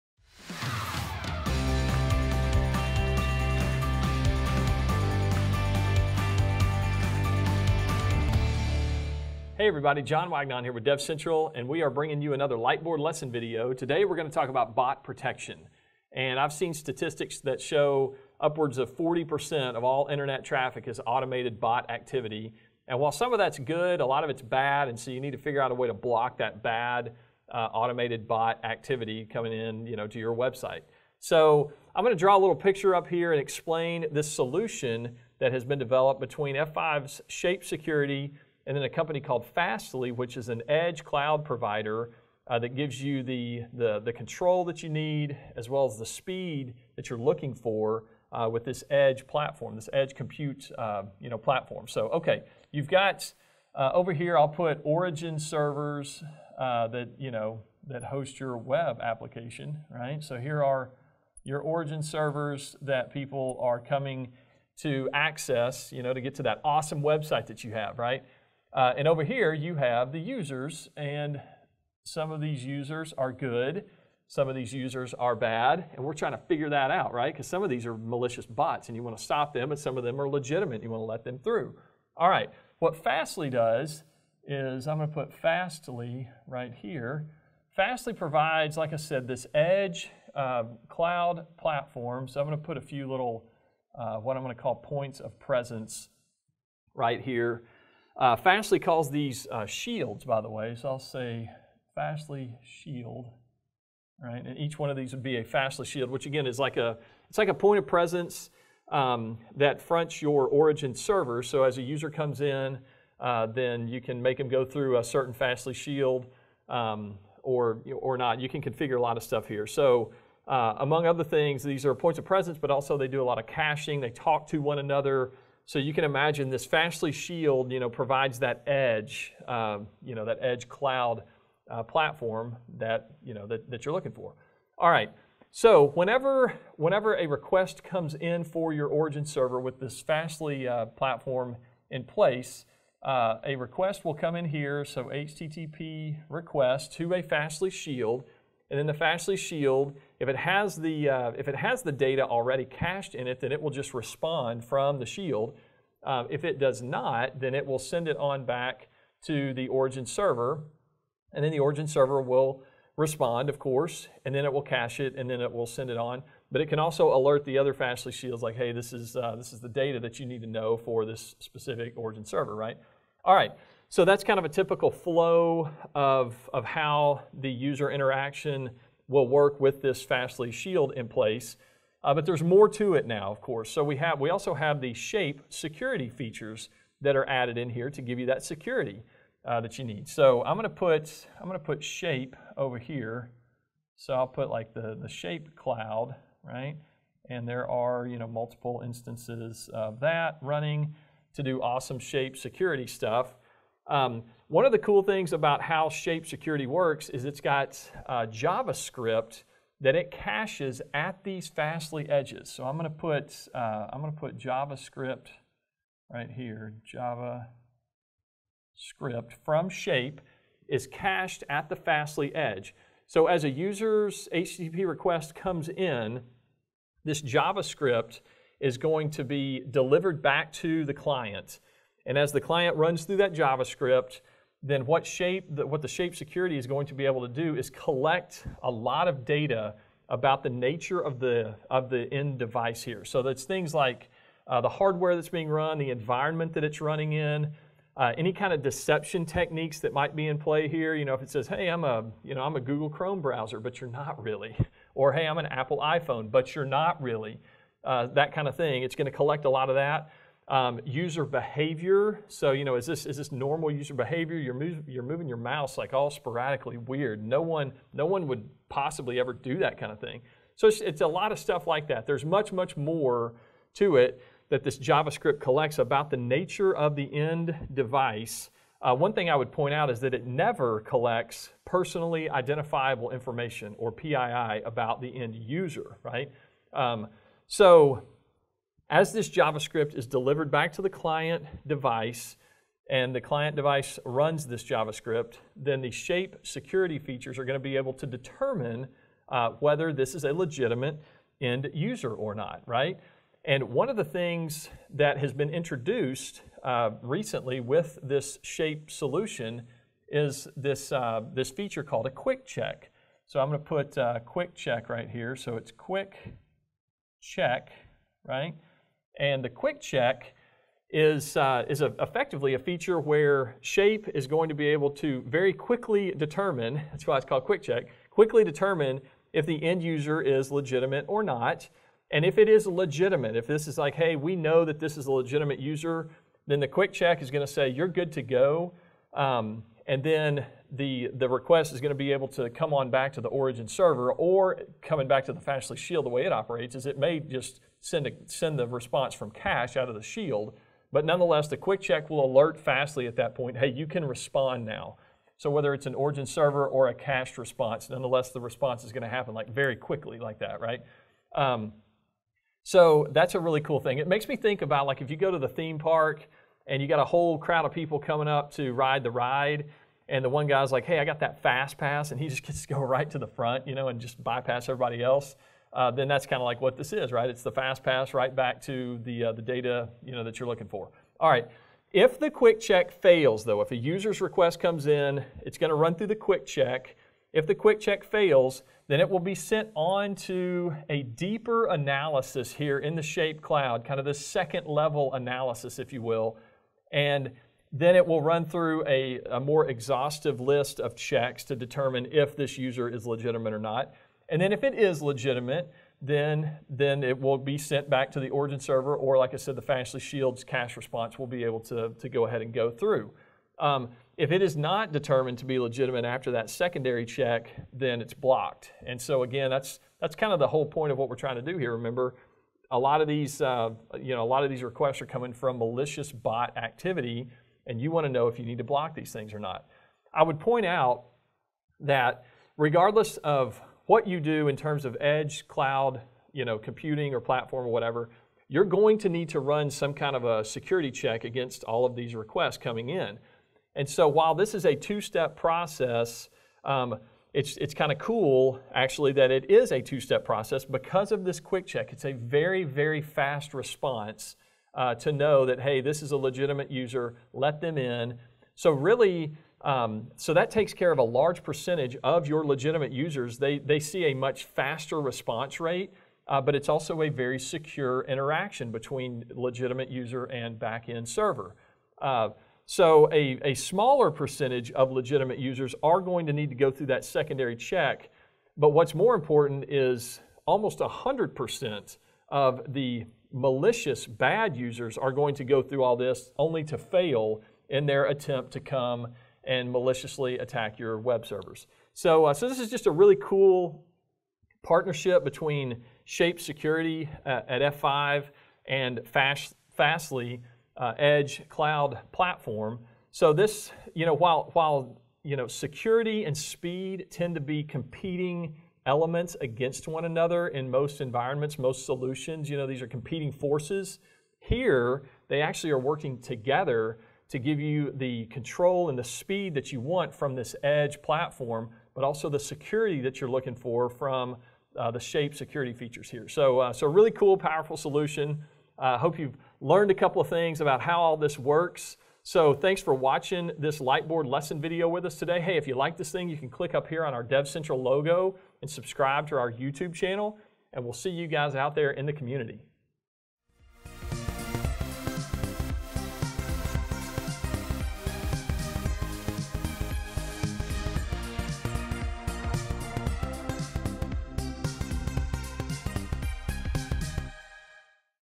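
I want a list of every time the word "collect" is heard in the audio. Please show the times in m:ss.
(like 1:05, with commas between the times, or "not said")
3:57, 4:19, 4:35, 4:40.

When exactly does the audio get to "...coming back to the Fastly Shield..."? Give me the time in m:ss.
5:44.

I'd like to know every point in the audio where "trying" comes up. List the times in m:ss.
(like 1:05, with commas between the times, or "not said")
1:16, 7:01.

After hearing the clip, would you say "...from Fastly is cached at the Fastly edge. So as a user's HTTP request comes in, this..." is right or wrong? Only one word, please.
wrong.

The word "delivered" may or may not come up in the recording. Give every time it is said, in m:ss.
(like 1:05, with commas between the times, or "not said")
3:49, 4:50.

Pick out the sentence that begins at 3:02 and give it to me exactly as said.
Uh, but there's more to it now, of course.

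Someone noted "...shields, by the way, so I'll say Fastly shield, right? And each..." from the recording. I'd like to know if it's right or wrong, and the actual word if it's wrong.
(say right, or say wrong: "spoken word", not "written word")
right.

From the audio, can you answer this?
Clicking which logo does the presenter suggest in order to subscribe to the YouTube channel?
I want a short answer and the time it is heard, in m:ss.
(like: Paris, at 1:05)
DevCentral, at 8:57.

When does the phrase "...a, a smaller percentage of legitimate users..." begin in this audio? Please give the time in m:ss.
7:53.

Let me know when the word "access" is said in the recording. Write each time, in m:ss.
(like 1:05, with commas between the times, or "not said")
1:05.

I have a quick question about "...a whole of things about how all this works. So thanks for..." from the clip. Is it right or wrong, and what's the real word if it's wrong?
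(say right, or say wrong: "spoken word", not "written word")
wrong: "couple", not "whole".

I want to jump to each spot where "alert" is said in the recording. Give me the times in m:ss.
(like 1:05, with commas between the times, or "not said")
2:47, 5:52.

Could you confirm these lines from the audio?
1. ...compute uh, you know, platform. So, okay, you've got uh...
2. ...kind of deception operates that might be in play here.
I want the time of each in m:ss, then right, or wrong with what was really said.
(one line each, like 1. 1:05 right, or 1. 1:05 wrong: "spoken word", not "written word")
1. 0:50 right
2. 4:08 wrong: "techniques", not "operates".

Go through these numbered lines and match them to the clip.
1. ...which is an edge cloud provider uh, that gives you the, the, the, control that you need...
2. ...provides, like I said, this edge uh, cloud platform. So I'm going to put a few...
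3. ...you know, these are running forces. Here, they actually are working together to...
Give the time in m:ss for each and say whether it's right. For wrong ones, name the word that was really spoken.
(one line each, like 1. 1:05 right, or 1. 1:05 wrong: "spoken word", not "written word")
1. 0:40 right
2. 1:28 right
3. 8:32 wrong: "competing", not "running".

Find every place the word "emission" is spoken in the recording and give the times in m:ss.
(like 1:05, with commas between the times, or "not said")
not said.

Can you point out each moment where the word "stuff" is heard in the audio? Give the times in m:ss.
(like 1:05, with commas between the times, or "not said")
1:59, 3:22, 4:31.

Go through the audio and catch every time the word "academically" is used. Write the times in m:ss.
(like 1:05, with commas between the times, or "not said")
not said.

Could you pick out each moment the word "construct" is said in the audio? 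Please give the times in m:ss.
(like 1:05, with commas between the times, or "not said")
not said.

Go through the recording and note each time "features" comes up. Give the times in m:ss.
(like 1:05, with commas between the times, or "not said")
3:06, 4:56, 5:11, 5:22, 8:45.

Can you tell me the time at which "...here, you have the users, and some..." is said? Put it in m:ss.
1:09.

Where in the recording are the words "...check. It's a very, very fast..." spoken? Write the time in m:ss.
7:31.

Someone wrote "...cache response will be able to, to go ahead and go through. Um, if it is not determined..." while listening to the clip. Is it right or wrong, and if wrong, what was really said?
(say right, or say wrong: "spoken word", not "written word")
right.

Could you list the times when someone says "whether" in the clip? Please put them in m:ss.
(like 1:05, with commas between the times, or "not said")
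4:59, 5:55.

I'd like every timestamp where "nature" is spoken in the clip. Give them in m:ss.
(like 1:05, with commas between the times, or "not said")
4:00, 4:36.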